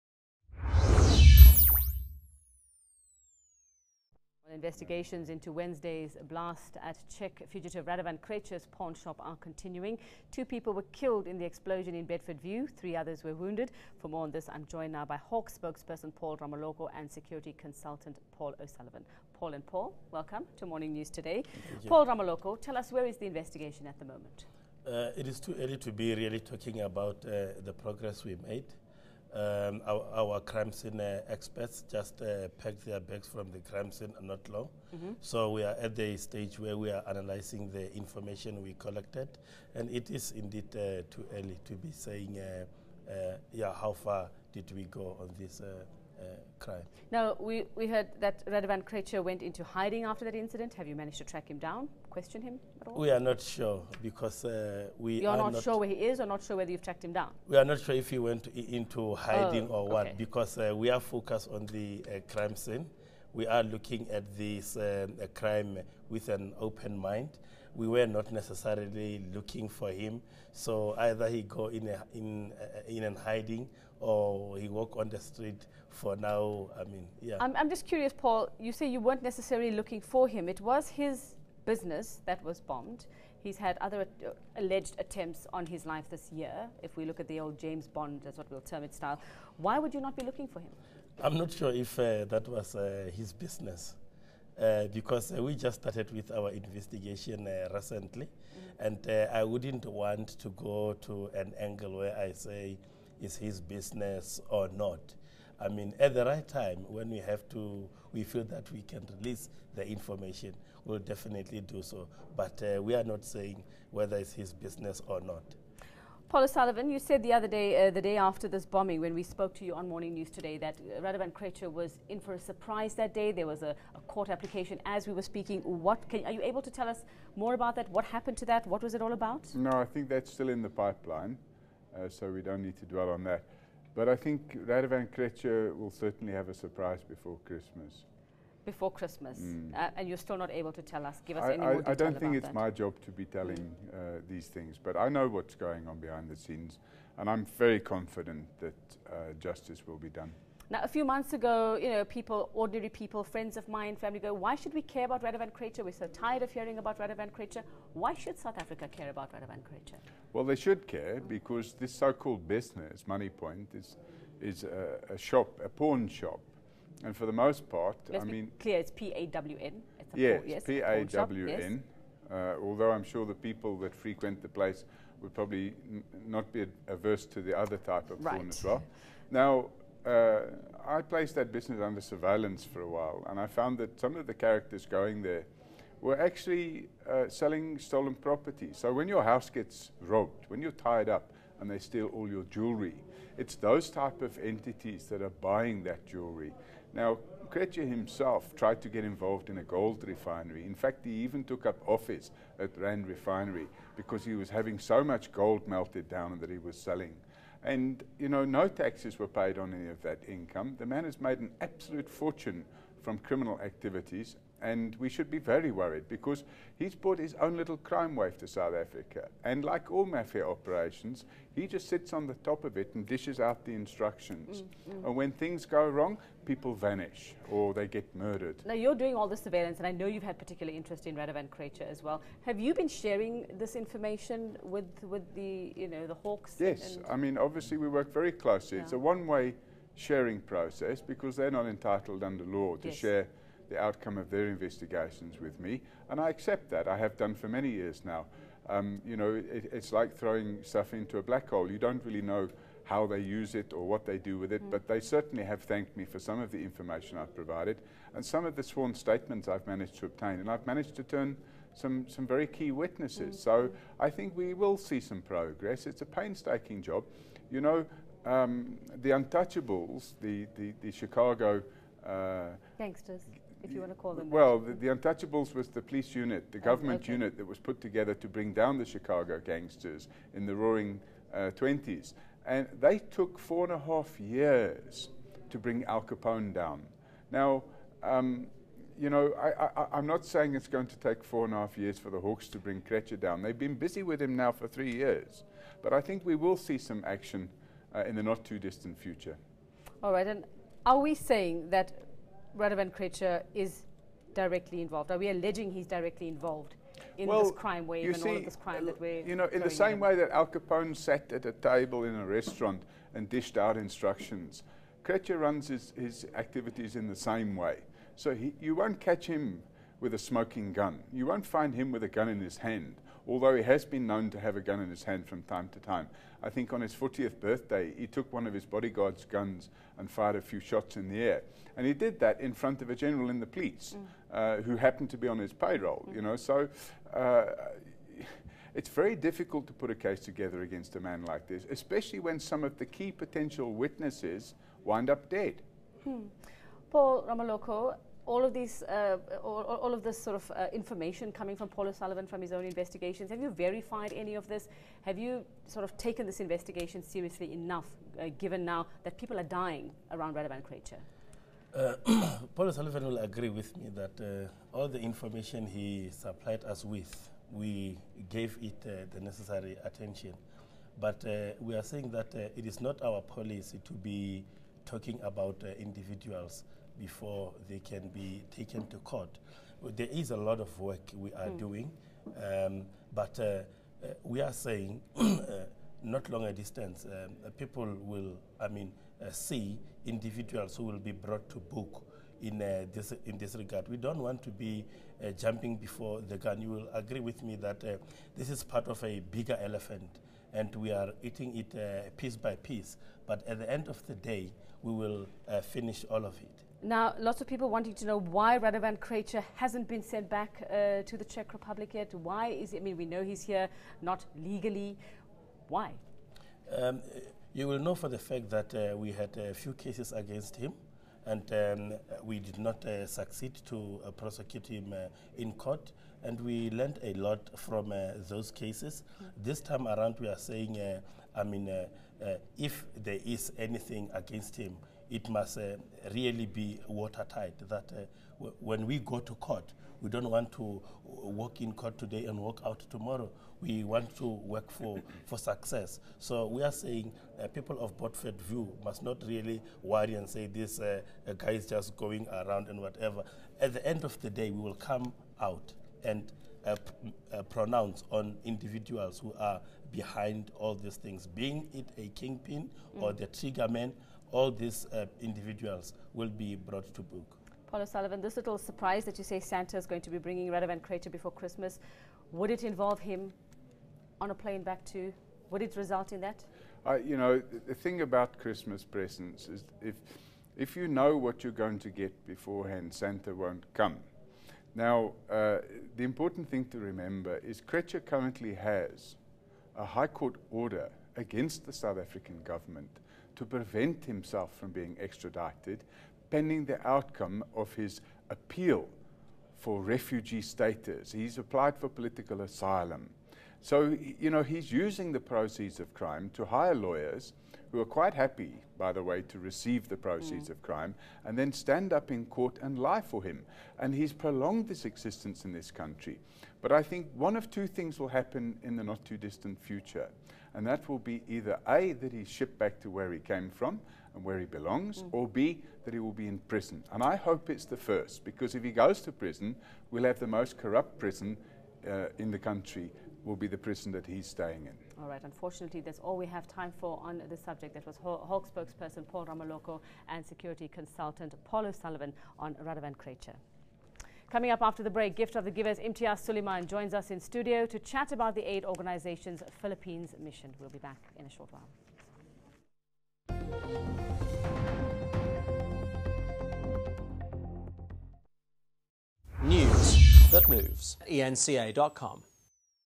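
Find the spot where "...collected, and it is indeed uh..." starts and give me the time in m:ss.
0:38.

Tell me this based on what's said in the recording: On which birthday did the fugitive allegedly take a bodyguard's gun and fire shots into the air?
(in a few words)
40th.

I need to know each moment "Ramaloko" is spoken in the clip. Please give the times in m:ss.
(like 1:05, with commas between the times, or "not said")
0:16, 0:22, 5:47, 8:59.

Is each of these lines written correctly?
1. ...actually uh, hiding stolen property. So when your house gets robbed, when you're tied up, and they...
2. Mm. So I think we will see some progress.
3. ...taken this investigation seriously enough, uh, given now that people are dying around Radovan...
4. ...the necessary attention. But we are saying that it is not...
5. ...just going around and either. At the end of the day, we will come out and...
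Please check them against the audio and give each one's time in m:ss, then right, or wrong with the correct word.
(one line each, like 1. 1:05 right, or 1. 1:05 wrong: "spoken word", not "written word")
1. 3:06 wrong: "selling", not "hiding"
2. 4:23 right
3. 5:55 right
4. 6:09 right
5. 7:31 wrong: "whatever", not "either".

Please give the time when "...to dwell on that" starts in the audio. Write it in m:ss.
2:12.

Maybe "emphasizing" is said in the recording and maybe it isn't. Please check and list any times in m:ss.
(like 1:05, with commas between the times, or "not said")
not said.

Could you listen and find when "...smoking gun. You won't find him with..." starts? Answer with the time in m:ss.
5:20.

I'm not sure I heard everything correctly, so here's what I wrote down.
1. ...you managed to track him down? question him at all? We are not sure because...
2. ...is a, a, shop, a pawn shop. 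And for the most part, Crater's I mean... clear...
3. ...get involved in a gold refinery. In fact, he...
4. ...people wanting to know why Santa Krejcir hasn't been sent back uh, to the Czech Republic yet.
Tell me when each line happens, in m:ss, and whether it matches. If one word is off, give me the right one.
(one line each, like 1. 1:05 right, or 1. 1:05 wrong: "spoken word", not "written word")
1. 0:50 right
2. 2:44 wrong: "Let", not "Crater"
3. 3:18 right
4. 6:47 wrong: "Radovan", not "Santa".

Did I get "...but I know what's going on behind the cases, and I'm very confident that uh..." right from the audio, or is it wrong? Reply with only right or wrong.
wrong.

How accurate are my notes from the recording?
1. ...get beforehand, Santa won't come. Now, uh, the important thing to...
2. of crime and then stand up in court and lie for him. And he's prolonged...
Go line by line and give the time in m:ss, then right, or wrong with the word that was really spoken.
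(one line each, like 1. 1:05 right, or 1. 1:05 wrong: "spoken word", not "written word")
1. 8:01 right
2. 8:30 right.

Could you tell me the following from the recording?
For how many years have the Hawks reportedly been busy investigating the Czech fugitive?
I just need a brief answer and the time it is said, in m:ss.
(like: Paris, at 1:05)
3 years, at 4:54.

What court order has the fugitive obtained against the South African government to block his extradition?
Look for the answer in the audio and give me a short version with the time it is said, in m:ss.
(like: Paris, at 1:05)
High Court order, at 8:09.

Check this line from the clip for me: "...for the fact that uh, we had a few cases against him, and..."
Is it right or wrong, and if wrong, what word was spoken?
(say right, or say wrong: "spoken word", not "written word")
right.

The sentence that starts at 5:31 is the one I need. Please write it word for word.
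And he did that in front of a general in the police mm.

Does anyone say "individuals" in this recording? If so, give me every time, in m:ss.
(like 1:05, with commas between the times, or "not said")
6:15, 6:30, 7:38, 7:45.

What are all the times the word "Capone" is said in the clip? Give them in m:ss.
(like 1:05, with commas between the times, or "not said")
4:46, 5:10.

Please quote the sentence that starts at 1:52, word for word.
But uh, we are not saying whether it's his business or not.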